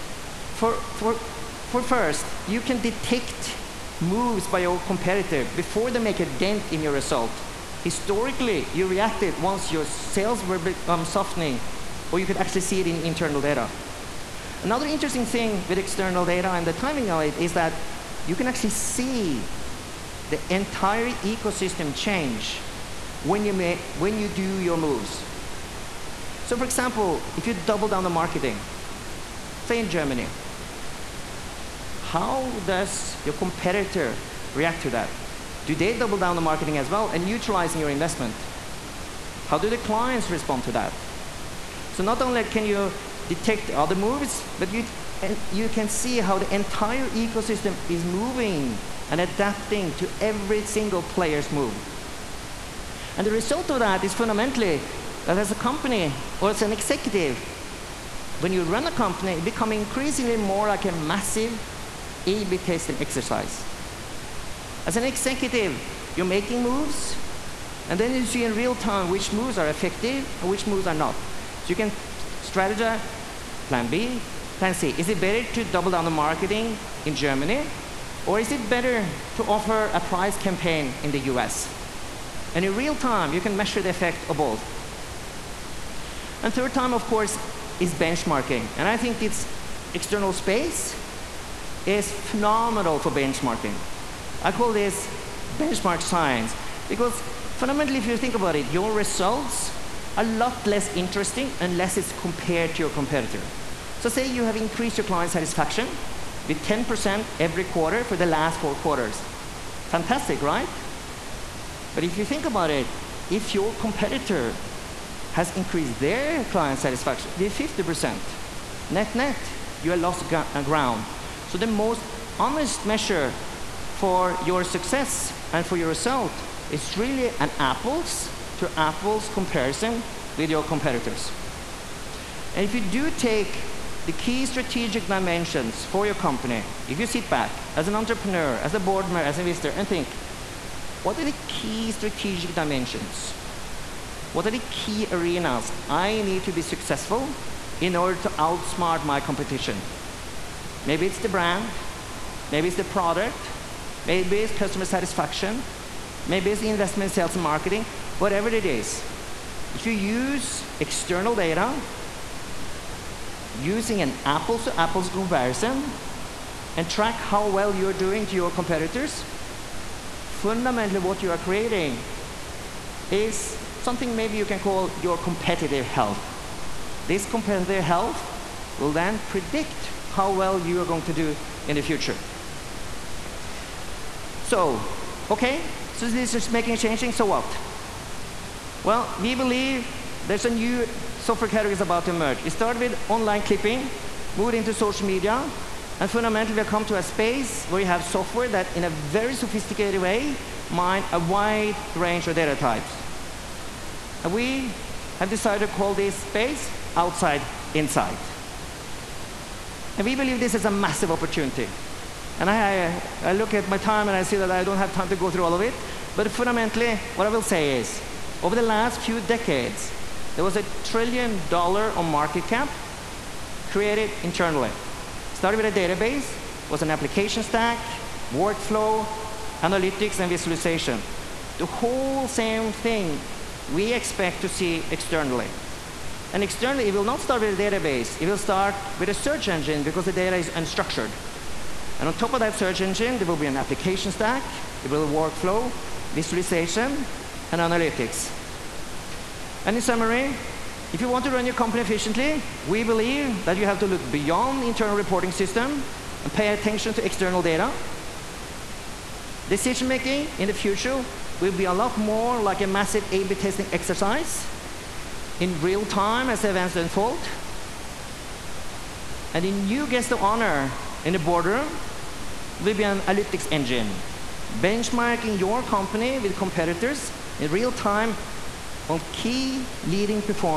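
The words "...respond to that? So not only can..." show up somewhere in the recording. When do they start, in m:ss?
0:40.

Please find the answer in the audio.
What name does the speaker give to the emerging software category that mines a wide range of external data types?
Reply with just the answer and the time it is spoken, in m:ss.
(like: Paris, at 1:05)
outside insight, at 3:26.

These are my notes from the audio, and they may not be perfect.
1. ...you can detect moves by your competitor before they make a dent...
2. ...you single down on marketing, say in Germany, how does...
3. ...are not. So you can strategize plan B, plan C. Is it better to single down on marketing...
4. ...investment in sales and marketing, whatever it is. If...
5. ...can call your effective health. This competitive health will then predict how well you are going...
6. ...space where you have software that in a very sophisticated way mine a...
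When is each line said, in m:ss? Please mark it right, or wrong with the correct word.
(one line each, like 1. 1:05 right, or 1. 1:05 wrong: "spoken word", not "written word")
1. 0:02 right
2. 0:27 wrong: "double", not "single"
3. 1:10 wrong: "double", not "single"
4. 2:36 right
5. 2:54 wrong: "competitive", not "effective"
6. 3:17 right.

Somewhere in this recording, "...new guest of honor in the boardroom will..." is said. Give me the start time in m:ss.
4:29.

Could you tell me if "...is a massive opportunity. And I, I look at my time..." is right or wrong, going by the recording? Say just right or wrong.
right.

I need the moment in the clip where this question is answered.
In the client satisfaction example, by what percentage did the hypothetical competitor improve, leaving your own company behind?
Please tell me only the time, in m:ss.
1:57.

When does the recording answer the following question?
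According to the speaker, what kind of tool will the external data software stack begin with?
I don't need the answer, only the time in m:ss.
3:59.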